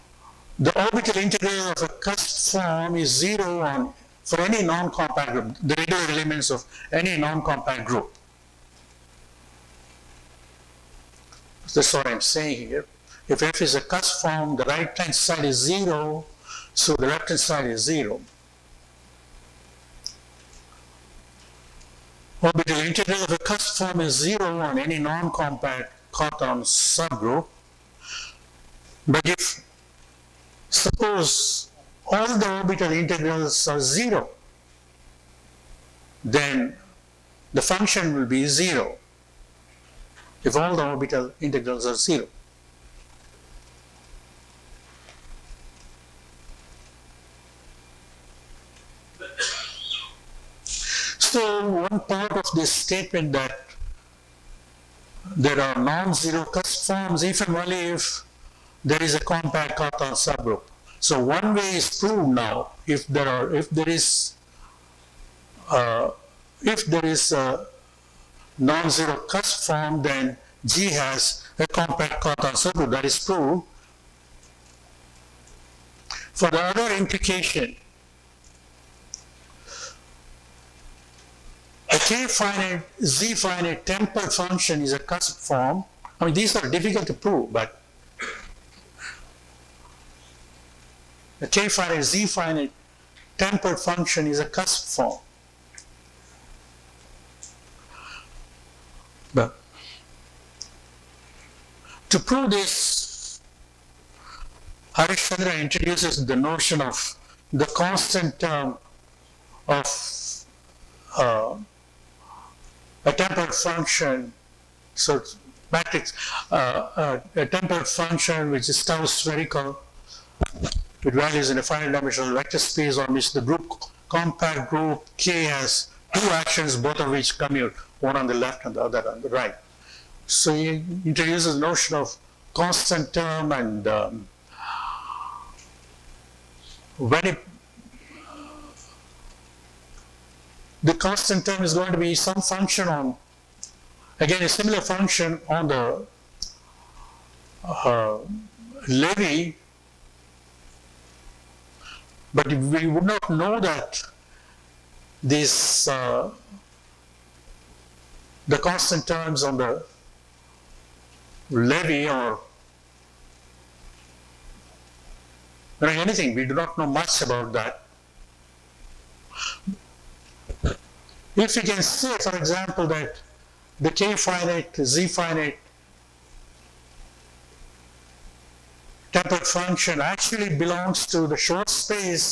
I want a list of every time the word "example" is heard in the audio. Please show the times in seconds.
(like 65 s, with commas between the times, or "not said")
172 s.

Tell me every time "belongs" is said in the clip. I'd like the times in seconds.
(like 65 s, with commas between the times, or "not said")
180 s.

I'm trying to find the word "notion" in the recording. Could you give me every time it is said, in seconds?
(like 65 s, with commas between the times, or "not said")
106 s, 131 s.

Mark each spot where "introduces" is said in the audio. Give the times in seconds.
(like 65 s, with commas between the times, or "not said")
105 s, 131 s.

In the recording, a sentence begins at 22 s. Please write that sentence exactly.
the integral of the cusp form is 0 on any non-compact Cartan subgroup.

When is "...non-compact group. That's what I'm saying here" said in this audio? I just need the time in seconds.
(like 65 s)
7 s.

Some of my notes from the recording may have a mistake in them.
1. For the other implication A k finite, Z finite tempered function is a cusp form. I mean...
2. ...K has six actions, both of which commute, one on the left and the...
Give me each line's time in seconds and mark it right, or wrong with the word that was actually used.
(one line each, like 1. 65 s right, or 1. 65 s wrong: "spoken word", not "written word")
1. 76 s right
2. 125 s wrong: "two", not "six".